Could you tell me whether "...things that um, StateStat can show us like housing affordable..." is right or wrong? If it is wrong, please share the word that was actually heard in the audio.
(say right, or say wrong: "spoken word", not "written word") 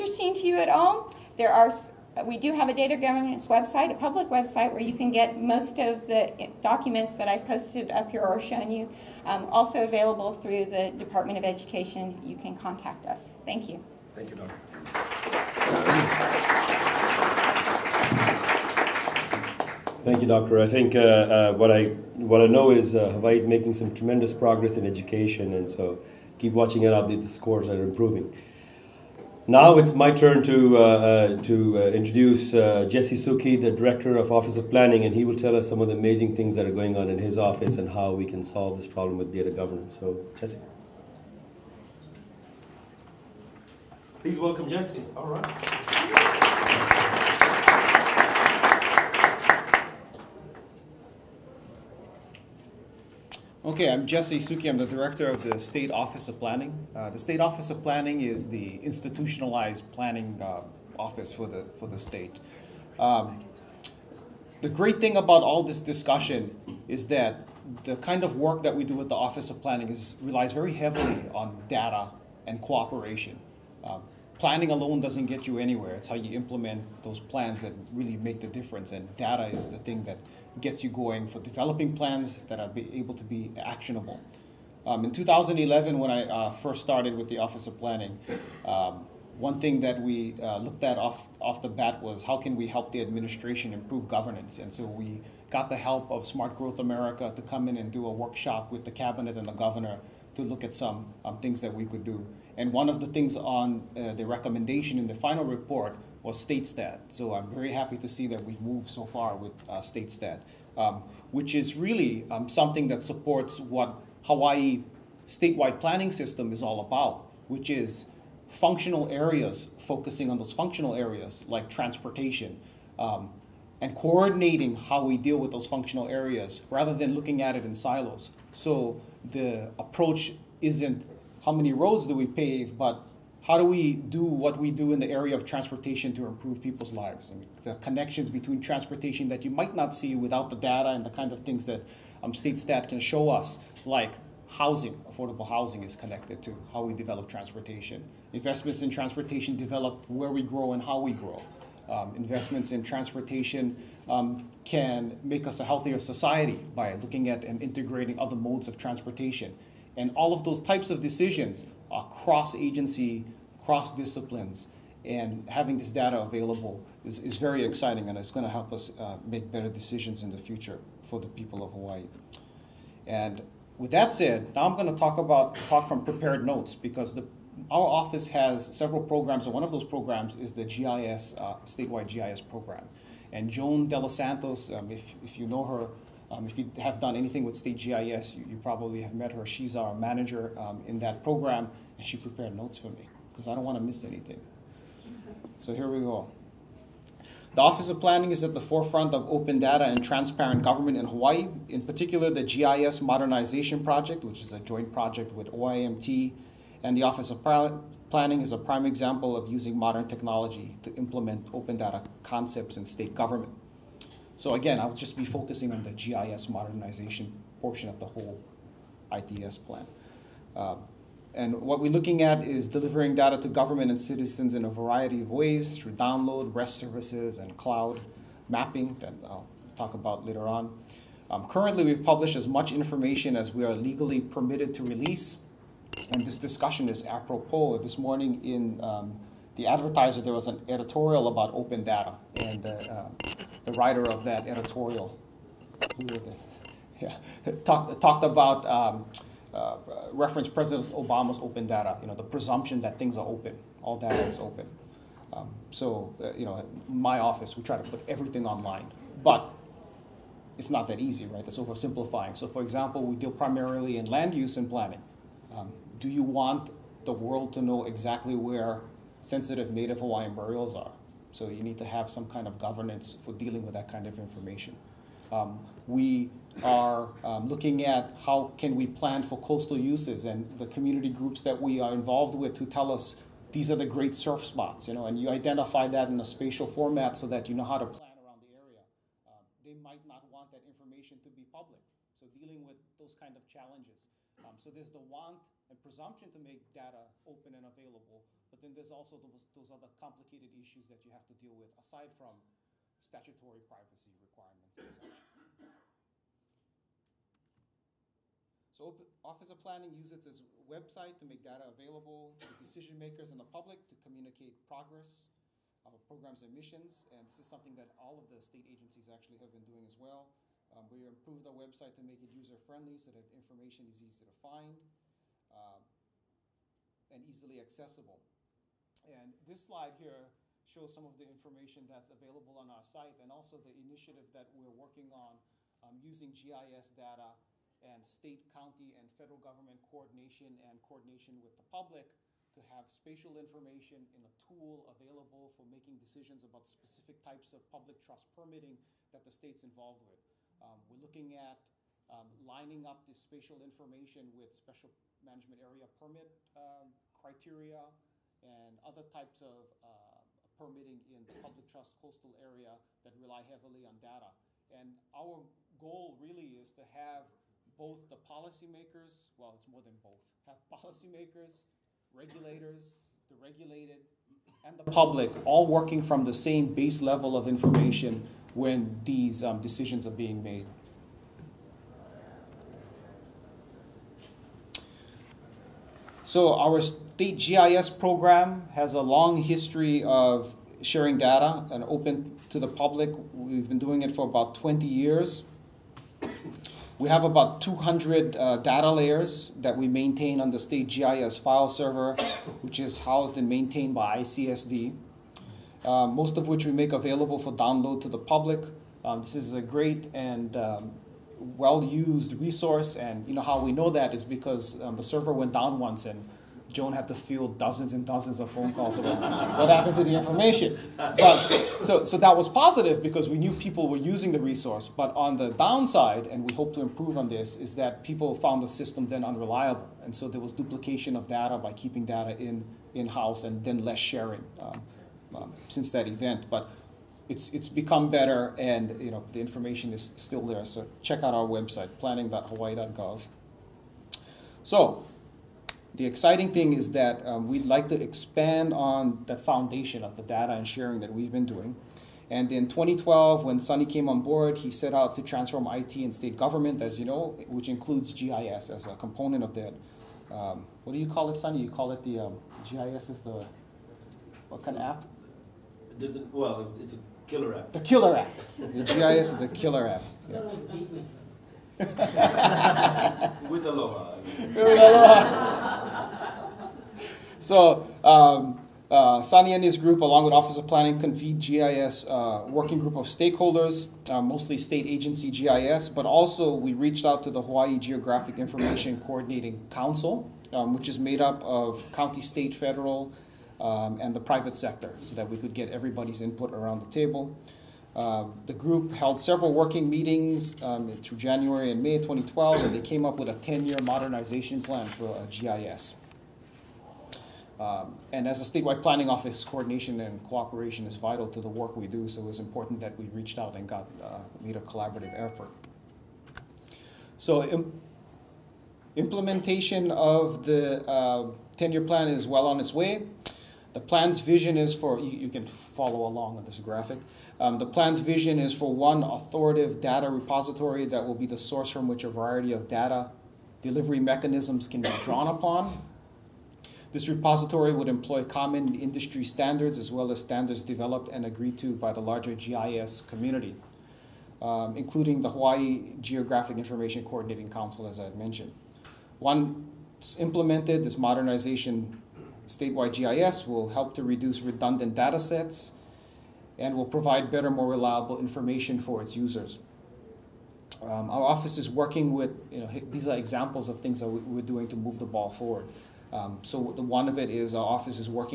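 right.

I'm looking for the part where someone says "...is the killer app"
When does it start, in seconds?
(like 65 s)
469 s.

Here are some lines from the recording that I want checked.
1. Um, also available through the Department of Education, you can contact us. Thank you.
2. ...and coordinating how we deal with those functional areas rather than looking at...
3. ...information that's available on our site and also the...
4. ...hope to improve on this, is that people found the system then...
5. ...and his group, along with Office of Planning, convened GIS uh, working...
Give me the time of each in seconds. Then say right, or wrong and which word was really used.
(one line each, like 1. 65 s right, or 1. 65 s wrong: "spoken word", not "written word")
1. 9 s right
2. 123 s right
3. 331 s right
4. 426 s right
5. 479 s right.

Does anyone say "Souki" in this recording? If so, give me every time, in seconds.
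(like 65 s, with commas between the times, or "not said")
33 s, 54 s.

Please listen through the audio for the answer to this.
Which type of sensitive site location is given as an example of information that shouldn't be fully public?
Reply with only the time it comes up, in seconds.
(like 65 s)
269 s.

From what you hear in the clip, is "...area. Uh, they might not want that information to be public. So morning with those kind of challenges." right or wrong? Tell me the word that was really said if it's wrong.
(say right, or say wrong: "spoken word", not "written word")
wrong: "dealing", not "morning".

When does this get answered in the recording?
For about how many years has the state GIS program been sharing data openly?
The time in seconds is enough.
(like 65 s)
394 s.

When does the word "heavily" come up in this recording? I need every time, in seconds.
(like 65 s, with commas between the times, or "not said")
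70 s, 363 s.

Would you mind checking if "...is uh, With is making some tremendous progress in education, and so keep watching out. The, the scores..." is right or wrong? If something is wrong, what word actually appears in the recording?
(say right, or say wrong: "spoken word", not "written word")
wrong: "Hawaii", not "With".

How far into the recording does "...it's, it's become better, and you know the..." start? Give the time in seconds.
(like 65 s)
437 s.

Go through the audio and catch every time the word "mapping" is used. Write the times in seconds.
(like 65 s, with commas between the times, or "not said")
228 s.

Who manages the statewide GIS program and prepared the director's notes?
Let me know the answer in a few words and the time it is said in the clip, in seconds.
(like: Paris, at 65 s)
Joan De Los Santos, at 183 s.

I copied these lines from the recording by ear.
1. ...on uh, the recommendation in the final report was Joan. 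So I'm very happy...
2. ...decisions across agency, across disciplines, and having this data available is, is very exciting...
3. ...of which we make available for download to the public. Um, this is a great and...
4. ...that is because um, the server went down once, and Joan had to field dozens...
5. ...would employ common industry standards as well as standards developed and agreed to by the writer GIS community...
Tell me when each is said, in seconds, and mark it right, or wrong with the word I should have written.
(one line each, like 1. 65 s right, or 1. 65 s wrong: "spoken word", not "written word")
1. 103 s wrong: "StateStat", not "Joan"
2. 161 s wrong: "cross", not "across"
3. 406 s right
4. 413 s right
5. 537 s wrong: "larger", not "writer".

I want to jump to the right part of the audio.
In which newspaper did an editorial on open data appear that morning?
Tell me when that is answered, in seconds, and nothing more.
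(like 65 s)
239 s.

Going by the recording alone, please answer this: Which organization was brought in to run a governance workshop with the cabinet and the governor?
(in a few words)
Smart Growth America.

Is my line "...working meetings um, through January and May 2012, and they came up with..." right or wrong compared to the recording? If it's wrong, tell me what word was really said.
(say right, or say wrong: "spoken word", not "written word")
right.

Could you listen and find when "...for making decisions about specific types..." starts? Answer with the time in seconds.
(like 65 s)
345 s.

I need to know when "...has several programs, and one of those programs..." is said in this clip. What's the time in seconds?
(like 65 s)
178 s.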